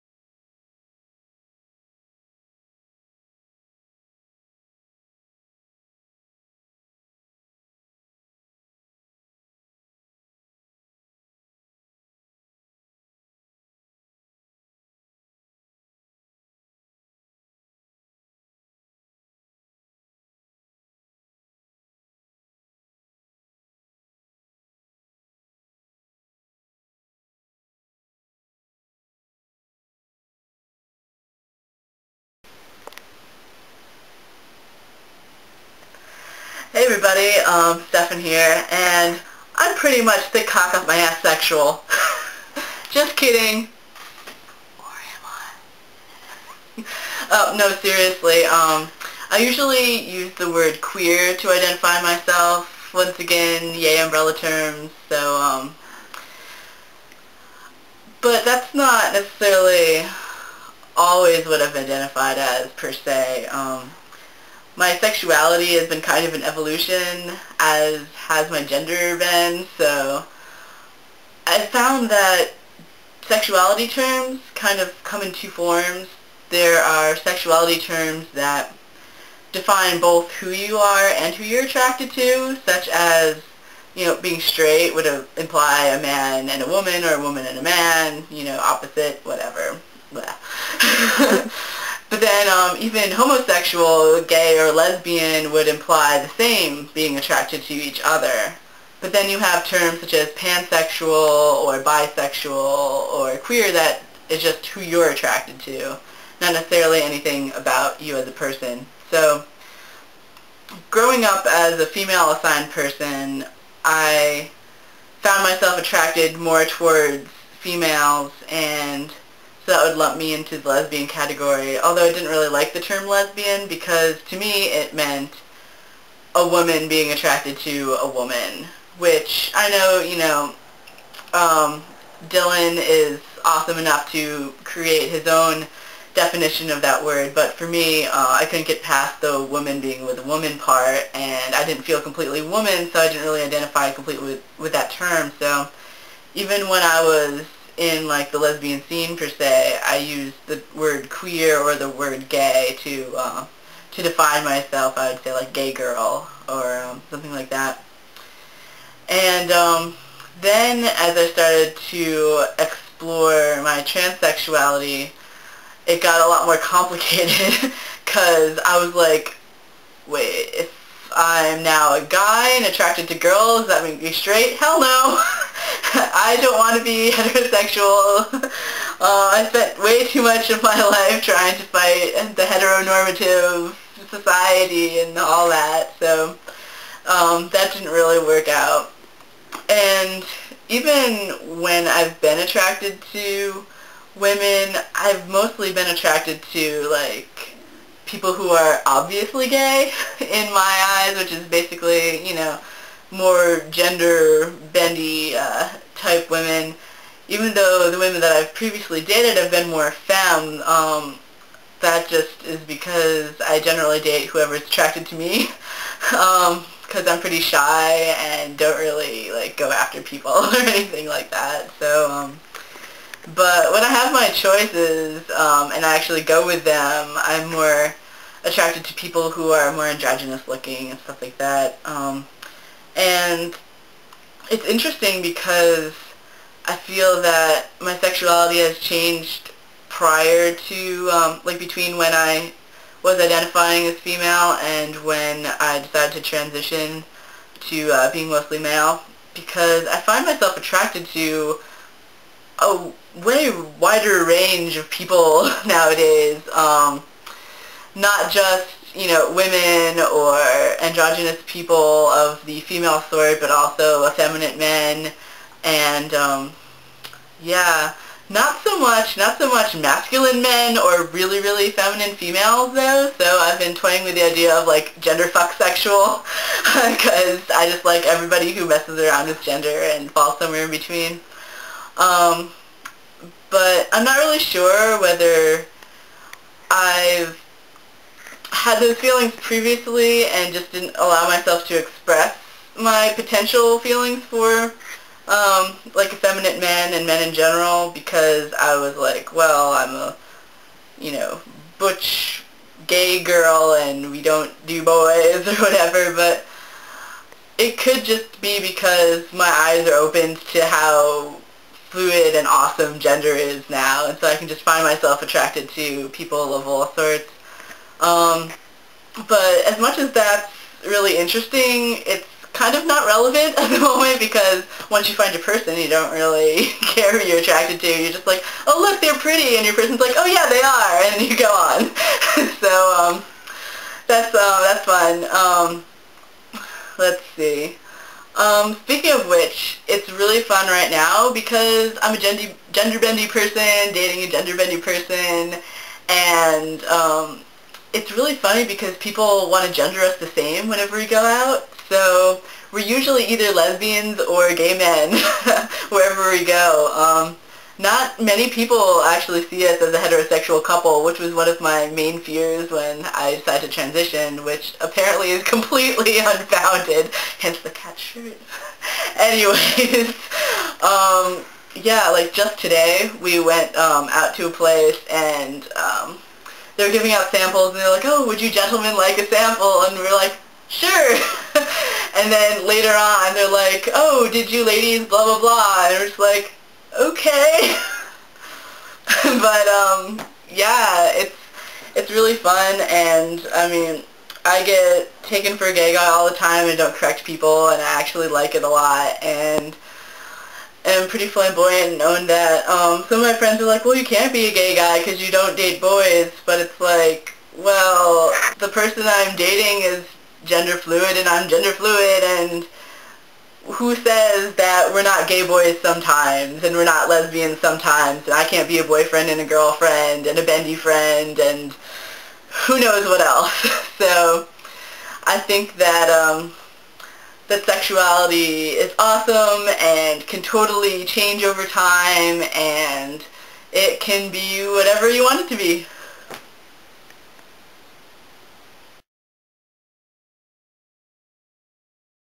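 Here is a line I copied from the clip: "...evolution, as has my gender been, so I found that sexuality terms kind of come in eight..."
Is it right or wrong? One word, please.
wrong.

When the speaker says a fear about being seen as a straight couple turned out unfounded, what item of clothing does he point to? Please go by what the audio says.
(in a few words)
cat shirt.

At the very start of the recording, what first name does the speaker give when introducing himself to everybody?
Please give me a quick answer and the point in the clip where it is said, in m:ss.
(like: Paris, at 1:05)
Stephan, at 0:37.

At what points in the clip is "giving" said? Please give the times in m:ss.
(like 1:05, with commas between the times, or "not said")
6:16.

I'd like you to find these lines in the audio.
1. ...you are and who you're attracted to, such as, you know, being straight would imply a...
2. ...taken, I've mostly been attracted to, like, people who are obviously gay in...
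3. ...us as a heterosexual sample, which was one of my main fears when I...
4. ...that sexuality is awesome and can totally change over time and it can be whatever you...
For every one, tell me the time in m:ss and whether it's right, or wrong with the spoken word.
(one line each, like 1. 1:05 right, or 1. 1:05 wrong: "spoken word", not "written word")
1. 1:20 right
2. 3:14 wrong: "women", not "taken"
3. 5:59 wrong: "couple", not "sample"
4. 7:07 right.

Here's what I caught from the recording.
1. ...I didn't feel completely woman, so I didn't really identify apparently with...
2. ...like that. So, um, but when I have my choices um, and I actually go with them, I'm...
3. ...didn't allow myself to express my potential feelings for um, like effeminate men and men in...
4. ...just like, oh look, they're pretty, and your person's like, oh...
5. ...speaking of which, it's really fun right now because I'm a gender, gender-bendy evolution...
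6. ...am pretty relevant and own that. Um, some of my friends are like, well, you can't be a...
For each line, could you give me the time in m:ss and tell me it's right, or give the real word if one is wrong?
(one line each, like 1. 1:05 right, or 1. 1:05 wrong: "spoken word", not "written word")
1. 2:21 wrong: "completely", not "apparently"
2. 3:41 right
3. 4:50 right
4. 5:28 right
5. 5:38 wrong: "person", not "evolution"
6. 6:40 wrong: "flamboyant", not "relevant".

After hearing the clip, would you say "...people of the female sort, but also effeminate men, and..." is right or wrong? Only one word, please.
right.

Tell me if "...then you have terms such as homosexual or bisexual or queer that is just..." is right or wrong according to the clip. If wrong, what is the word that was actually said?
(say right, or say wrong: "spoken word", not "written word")
wrong: "pansexual", not "homosexual".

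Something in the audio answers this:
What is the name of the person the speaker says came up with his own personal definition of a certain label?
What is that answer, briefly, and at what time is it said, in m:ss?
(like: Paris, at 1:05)
Dylan, at 2:12.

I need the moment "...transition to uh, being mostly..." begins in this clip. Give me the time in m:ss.
4:06.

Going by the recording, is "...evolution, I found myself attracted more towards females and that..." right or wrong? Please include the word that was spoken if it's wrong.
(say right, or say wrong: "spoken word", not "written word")
wrong: "person", not "evolution".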